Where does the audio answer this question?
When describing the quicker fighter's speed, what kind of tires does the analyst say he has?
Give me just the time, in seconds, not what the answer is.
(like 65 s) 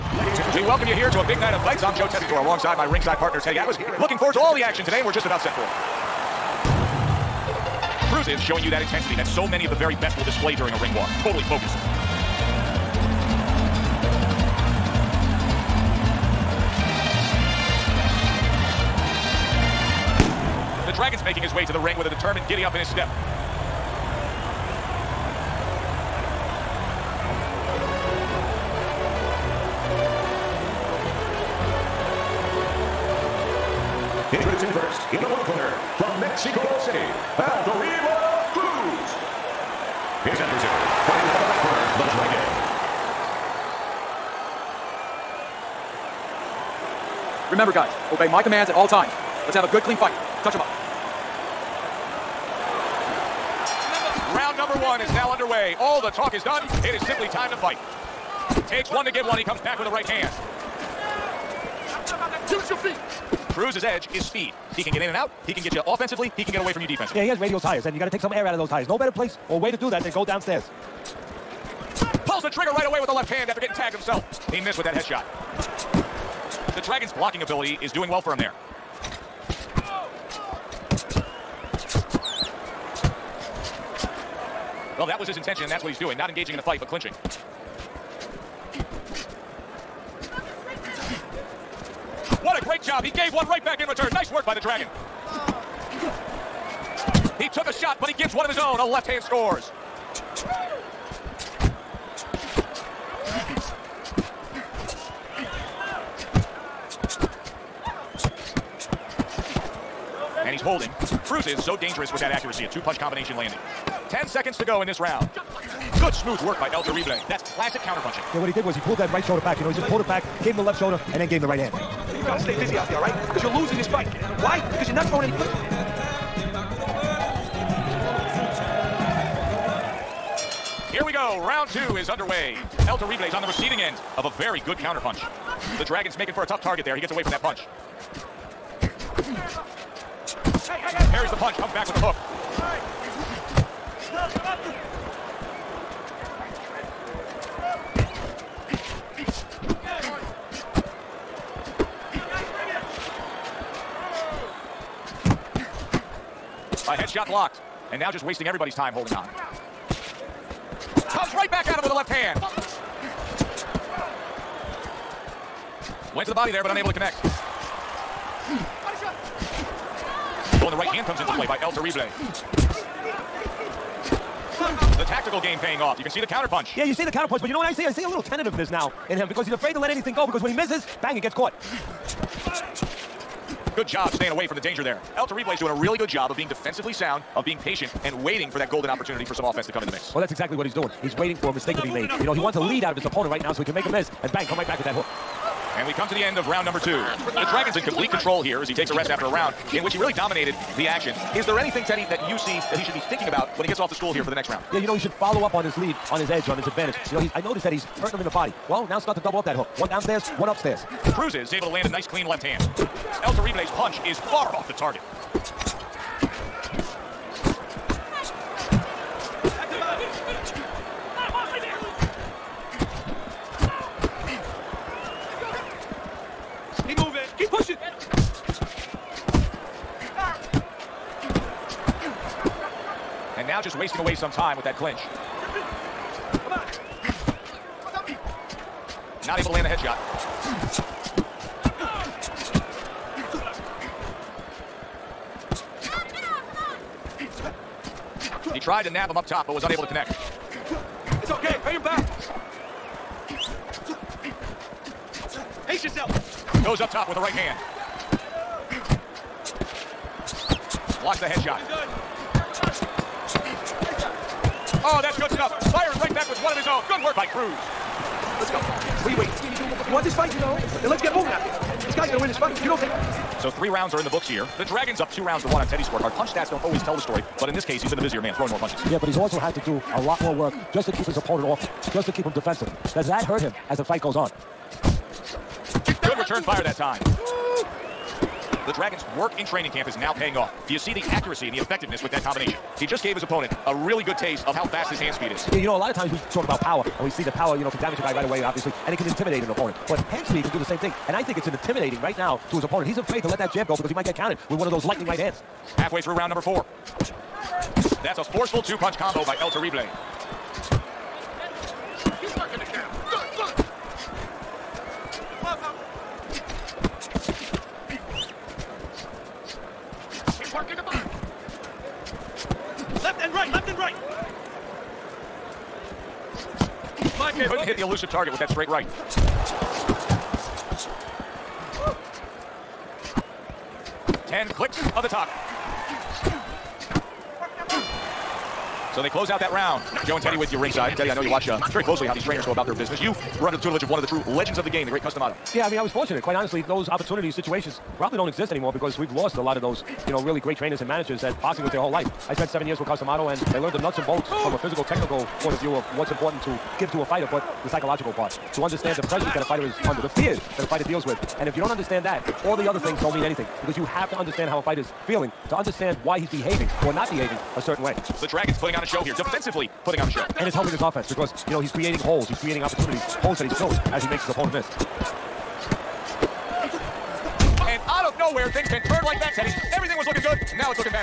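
67 s.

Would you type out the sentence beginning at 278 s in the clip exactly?
Yeah, but he's also had to do a lot more work just to keep his opponent off, just to keep him defensive.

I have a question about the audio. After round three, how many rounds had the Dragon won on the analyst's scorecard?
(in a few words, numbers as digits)
2.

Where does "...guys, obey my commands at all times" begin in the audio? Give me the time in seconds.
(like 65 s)
47 s.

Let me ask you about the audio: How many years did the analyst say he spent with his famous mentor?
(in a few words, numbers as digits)
7.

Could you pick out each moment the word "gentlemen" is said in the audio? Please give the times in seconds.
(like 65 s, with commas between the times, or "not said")
not said.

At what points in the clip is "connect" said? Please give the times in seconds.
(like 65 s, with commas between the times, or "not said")
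166 s, 249 s.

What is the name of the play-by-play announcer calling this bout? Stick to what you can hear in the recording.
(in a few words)
Joe Tessitore.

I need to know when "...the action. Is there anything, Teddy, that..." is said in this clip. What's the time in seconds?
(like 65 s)
200 s.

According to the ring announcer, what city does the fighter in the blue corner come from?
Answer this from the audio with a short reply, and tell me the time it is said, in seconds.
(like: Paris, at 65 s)
Mexico City, at 36 s.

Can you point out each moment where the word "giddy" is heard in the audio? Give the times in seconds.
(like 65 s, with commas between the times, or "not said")
22 s.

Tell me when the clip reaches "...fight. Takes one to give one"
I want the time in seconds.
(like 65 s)
57 s.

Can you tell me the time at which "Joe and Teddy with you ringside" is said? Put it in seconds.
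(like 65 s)
340 s.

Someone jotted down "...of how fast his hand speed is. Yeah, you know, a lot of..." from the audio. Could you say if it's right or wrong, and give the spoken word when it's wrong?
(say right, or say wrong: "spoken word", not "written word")
right.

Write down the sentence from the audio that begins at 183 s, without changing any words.
Good job staying away from the danger there.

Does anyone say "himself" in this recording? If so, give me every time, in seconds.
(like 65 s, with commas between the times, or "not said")
73 s.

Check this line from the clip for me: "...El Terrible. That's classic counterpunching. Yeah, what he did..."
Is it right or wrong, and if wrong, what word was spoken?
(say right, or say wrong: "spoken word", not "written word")
right.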